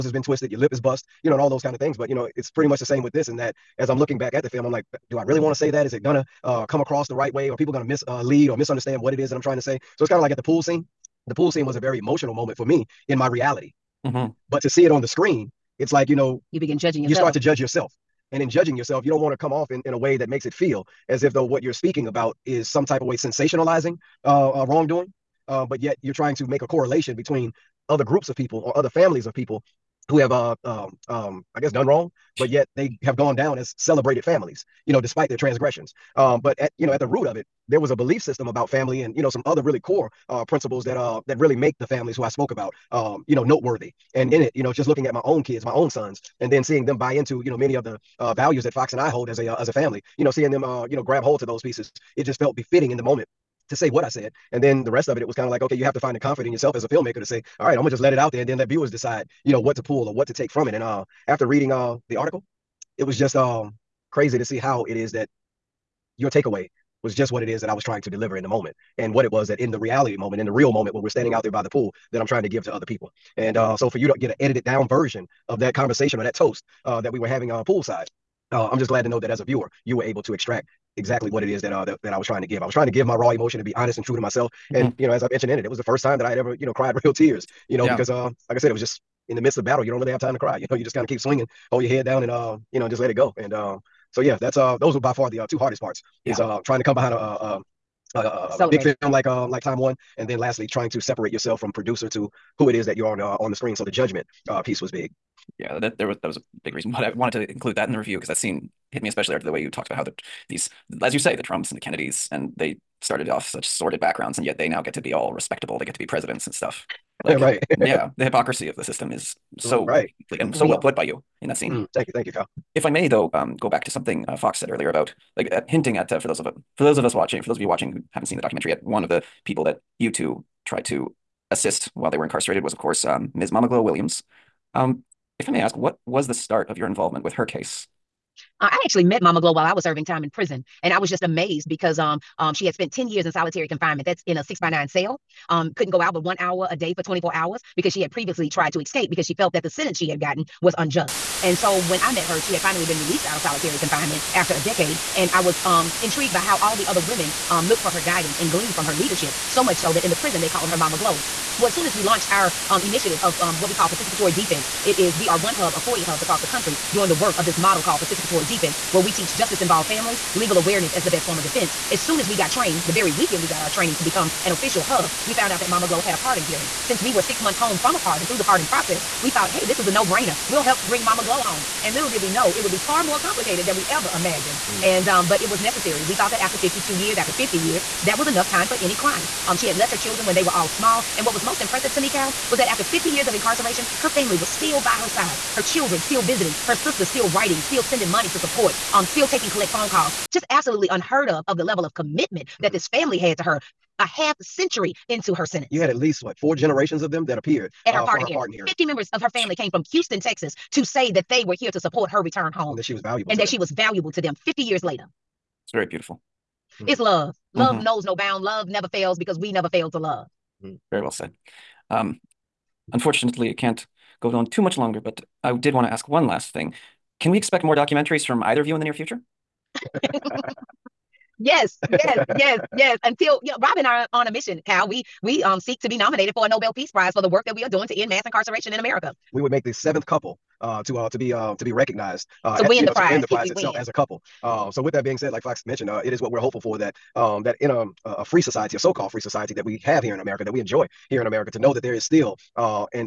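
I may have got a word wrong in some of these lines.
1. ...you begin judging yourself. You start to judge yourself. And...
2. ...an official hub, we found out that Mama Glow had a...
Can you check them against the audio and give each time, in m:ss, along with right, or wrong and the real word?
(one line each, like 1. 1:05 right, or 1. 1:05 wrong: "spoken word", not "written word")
1. 0:16 right
2. 2:54 right.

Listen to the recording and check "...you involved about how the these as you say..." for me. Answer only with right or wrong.
wrong.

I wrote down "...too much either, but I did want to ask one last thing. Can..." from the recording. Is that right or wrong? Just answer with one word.
wrong.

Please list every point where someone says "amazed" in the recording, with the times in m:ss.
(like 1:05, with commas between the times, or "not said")
2:21.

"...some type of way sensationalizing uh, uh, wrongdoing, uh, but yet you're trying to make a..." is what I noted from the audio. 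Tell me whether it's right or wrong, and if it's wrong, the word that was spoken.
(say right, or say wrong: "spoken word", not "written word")
right.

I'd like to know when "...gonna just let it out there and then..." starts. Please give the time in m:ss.
0:57.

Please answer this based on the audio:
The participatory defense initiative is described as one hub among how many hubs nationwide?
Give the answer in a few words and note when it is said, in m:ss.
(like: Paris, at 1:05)
40, at 2:45.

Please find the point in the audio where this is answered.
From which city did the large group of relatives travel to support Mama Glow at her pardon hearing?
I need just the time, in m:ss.
3:29.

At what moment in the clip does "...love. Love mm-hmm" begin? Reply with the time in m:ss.
3:36.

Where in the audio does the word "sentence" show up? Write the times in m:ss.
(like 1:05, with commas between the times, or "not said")
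2:29, 3:25.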